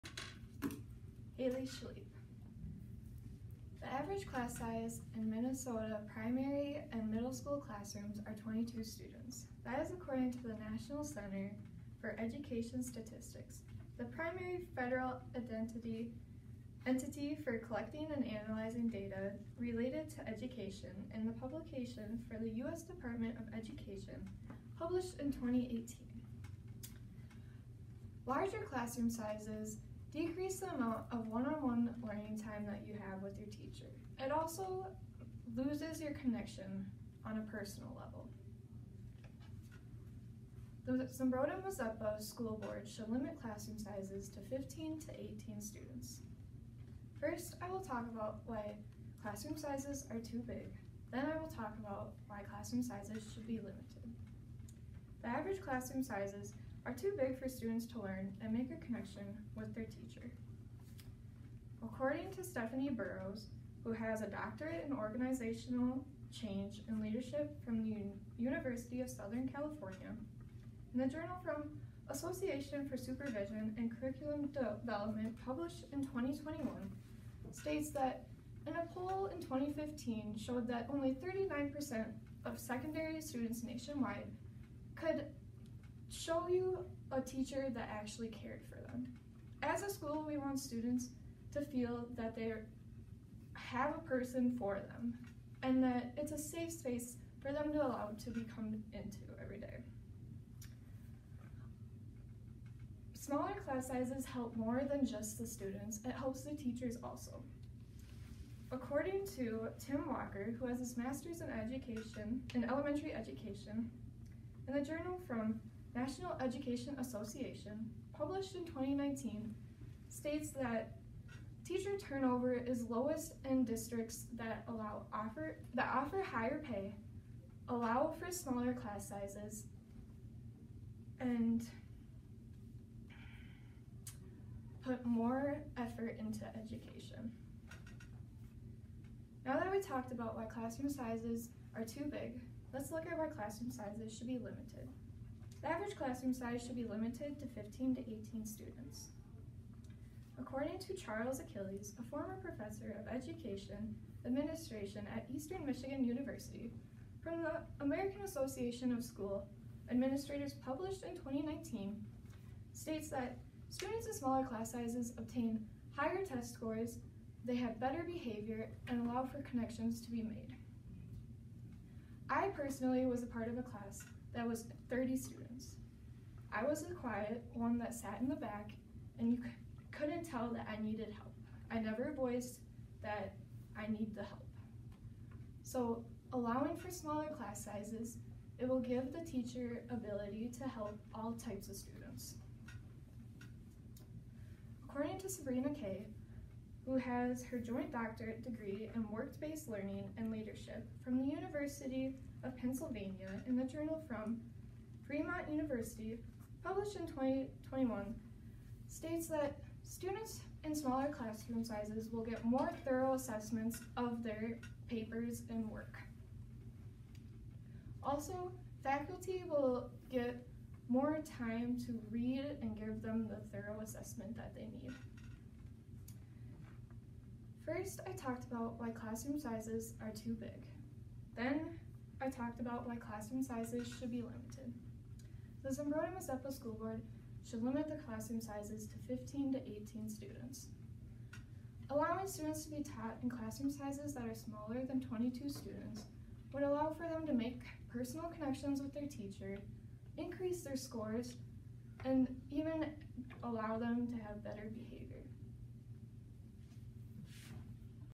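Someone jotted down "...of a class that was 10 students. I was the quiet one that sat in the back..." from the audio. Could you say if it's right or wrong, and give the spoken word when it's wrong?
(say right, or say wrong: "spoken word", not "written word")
wrong: "30", not "10".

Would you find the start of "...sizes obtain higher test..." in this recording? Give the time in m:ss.
2:44.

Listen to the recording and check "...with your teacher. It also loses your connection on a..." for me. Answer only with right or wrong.
right.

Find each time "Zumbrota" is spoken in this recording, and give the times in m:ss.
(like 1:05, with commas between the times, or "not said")
0:41, 3:55.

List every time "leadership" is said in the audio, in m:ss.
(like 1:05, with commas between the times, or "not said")
1:07, 3:20.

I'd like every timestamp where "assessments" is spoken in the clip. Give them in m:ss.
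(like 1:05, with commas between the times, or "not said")
3:33, 3:43.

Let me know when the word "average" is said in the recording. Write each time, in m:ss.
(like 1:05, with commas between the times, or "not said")
0:03, 0:55, 2:25.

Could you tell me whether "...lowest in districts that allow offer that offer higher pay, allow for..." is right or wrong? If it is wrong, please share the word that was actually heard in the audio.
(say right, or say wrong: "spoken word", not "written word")
right.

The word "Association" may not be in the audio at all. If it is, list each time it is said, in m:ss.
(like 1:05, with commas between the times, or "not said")
1:12, 1:56, 2:38.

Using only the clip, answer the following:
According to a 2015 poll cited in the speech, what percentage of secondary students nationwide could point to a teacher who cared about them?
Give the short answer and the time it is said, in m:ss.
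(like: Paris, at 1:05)
39%, at 1:21.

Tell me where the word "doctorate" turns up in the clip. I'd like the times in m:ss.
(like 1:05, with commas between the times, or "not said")
1:04, 3:17.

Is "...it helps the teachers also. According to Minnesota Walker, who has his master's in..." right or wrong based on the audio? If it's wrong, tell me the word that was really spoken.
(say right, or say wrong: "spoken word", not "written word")
wrong: "Tim", not "Minnesota".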